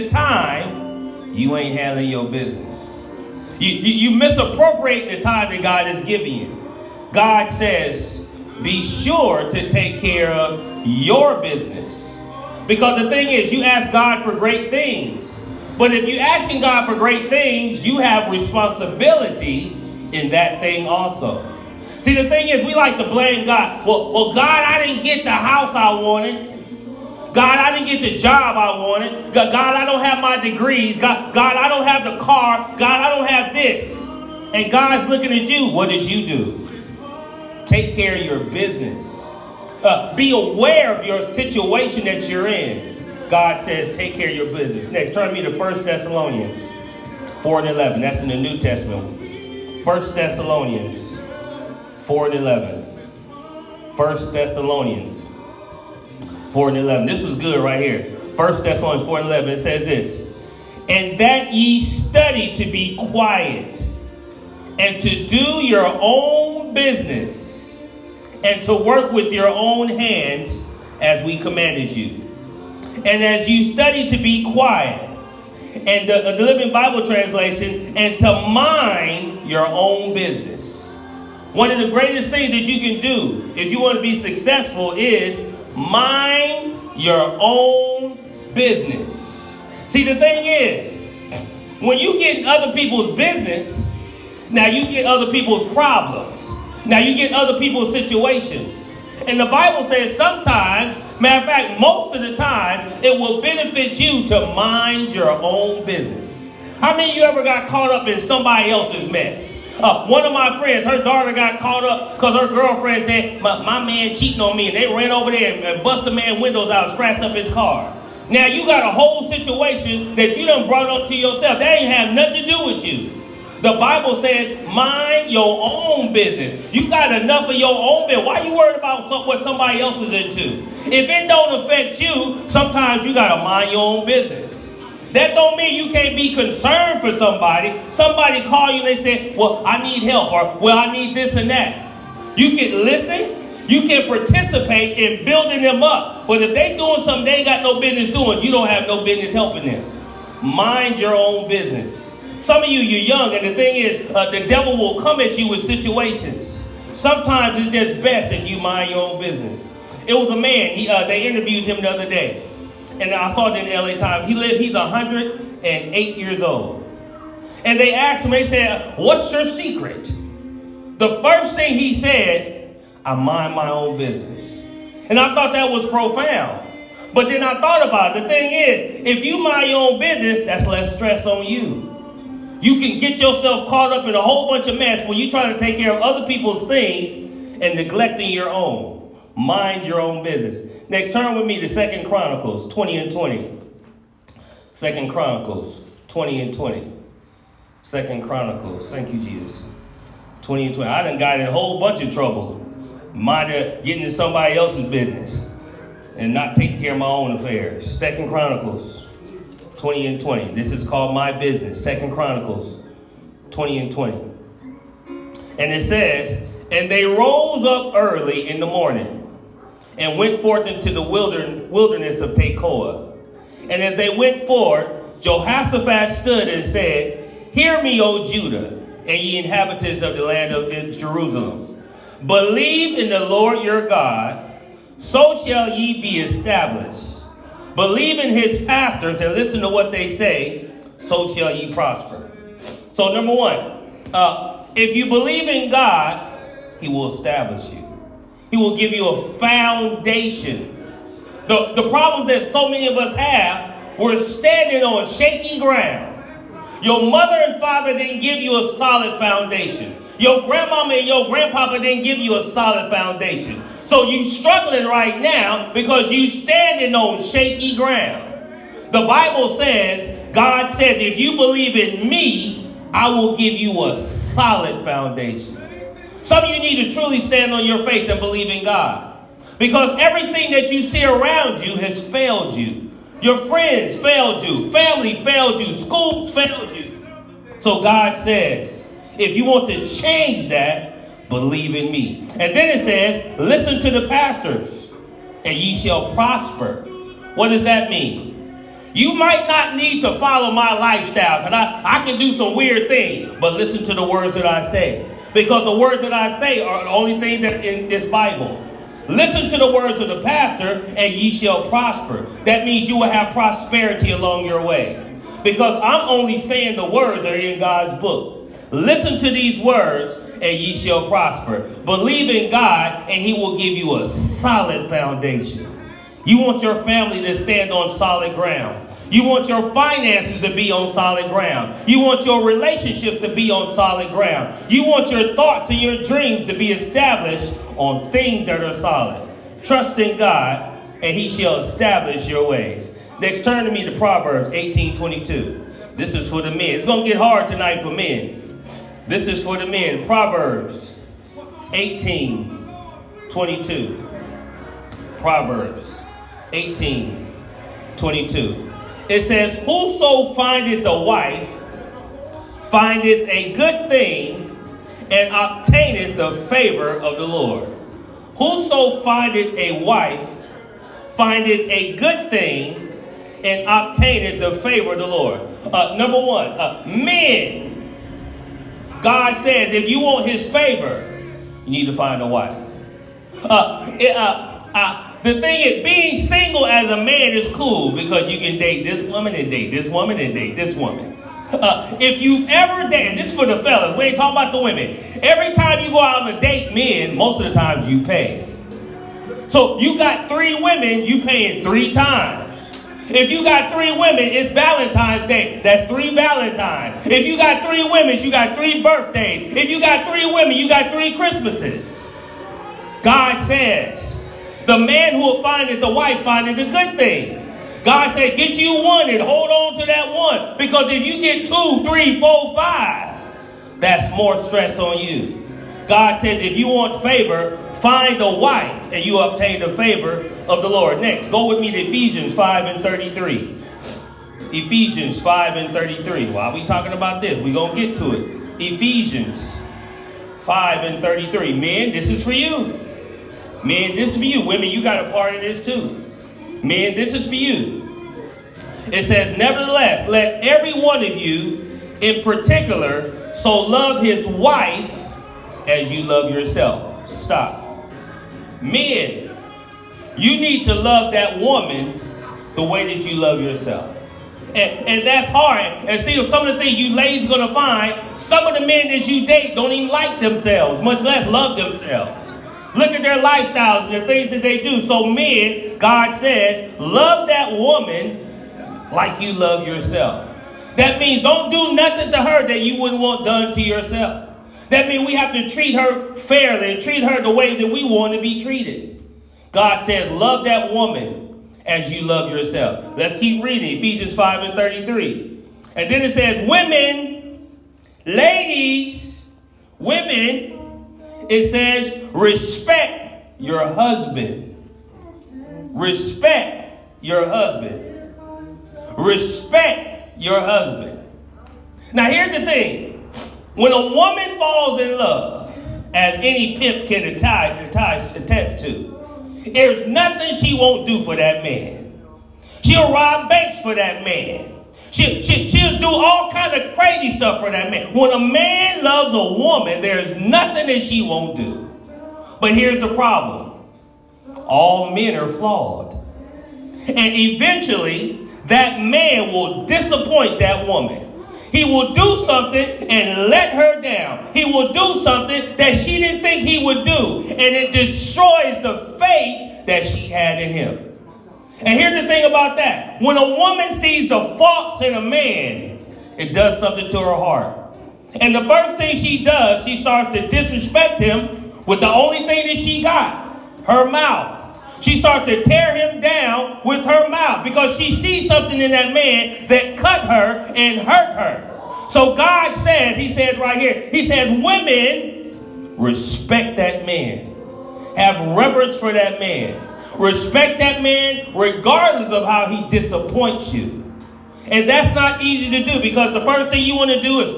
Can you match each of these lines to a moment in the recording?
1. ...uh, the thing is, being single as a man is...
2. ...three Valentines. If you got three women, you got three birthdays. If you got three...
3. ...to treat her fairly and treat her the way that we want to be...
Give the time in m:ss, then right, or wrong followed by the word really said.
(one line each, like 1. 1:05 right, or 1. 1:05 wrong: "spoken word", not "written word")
1. 6:24 right
2. 6:45 right
3. 8:05 right.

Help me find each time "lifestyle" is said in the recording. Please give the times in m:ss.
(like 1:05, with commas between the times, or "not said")
5:00, 7:53.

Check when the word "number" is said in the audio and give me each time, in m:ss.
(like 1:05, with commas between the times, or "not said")
4:03, 6:15.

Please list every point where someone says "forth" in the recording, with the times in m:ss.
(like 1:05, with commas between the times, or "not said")
3:40, 3:44.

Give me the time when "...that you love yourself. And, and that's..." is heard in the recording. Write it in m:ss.
7:42.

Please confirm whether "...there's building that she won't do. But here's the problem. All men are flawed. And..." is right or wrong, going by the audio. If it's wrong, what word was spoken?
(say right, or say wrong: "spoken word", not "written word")
wrong: "nothing", not "building".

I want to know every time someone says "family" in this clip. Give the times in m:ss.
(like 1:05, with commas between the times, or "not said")
4:44, 5:26.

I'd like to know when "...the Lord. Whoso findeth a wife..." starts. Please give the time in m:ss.
6:07.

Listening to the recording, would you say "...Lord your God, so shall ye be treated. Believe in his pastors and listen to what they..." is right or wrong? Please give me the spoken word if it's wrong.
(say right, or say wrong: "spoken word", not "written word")
wrong: "established", not "treated".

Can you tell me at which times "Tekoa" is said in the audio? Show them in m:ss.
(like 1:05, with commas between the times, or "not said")
3:42.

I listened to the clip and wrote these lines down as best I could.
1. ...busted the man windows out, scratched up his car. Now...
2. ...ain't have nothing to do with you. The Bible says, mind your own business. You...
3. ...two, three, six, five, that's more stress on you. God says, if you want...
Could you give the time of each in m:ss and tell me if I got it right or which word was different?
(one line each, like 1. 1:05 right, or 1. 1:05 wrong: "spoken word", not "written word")
1. 1:55 right
2. 2:01 right
3. 7:01 wrong: "four", not "six".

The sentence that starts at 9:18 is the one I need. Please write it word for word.
And the first thing she does, she starts to disrespect him with the only thing that she got, her mouth.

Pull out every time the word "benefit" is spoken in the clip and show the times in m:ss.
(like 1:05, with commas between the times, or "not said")
1:43.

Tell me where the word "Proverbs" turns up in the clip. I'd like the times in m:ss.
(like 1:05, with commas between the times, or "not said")
5:43, 5:50, 5:55.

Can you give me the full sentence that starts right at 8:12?
Let's keep reading Ephesians 5 and 33.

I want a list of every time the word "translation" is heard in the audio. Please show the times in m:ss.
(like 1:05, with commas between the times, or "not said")
1:17.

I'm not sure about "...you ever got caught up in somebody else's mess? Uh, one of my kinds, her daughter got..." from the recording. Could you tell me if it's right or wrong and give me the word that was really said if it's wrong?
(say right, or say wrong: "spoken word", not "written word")
wrong: "friends", not "kinds".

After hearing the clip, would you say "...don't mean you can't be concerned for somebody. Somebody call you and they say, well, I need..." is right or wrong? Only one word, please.
right.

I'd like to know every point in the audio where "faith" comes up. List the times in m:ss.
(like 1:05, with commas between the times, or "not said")
4:37, 9:08.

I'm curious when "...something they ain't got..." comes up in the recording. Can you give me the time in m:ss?
2:27.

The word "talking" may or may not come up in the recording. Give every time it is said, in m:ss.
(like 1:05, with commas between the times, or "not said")
6:34, 7:16.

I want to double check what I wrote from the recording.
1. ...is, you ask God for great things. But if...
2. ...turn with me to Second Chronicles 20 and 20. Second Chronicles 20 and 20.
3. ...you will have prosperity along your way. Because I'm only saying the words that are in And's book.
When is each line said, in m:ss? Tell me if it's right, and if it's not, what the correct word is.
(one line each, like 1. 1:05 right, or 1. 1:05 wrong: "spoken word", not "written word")
1. 0:13 right
2. 3:11 right
3. 5:12 wrong: "God", not "And".